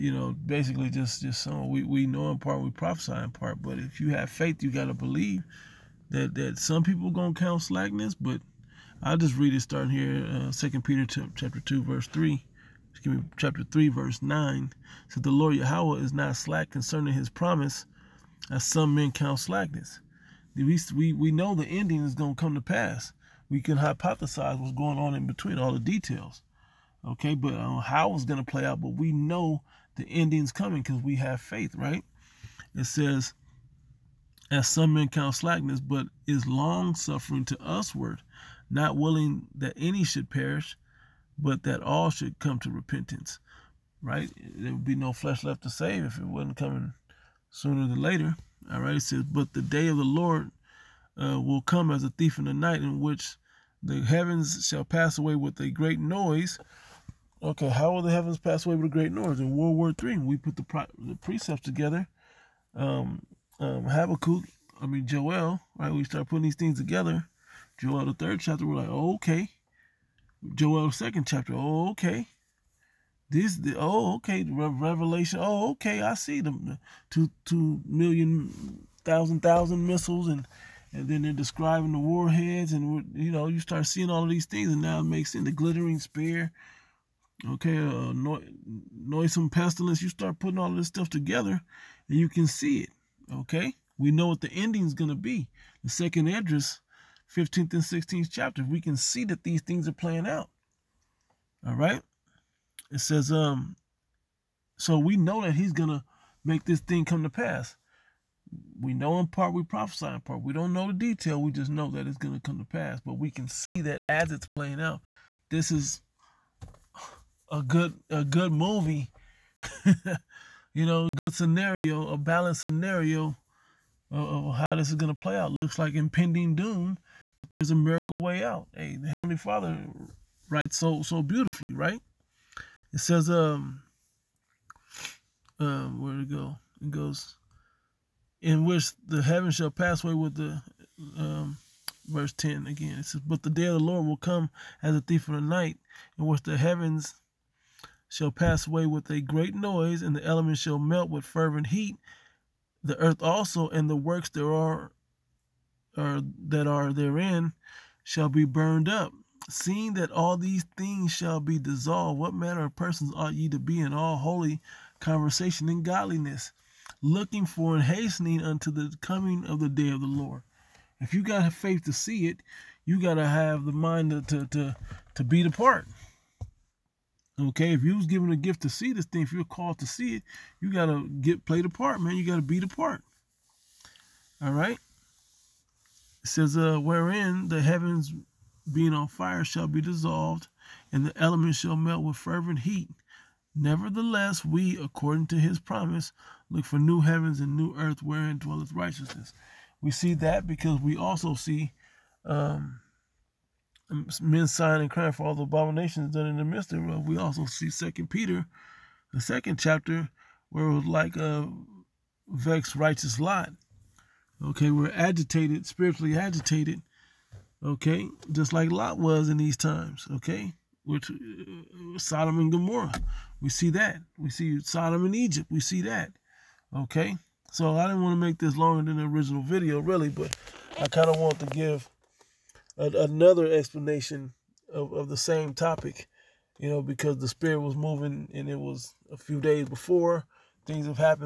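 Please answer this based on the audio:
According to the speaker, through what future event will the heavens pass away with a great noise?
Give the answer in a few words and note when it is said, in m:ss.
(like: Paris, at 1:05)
World War Three, at 0:59.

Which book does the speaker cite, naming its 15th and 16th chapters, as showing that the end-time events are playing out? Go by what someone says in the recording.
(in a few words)
Second Esdras.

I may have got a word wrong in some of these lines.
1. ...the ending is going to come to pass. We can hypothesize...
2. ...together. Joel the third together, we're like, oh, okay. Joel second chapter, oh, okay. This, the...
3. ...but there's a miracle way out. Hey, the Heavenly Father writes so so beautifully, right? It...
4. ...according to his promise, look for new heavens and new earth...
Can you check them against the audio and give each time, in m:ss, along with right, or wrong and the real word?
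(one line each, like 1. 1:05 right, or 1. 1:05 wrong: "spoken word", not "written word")
1. 0:21 right
2. 1:06 wrong: "chapter", not "together"
3. 2:07 right
4. 3:14 right.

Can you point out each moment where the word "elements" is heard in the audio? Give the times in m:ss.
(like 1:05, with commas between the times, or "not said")
2:30, 3:11.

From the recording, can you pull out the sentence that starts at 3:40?
Okay, which uh, Sodom and Gomorrah, we see that.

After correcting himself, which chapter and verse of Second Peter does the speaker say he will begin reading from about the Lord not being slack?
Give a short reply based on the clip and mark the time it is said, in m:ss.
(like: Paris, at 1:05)
Chapter 3, verse 9, at 0:13.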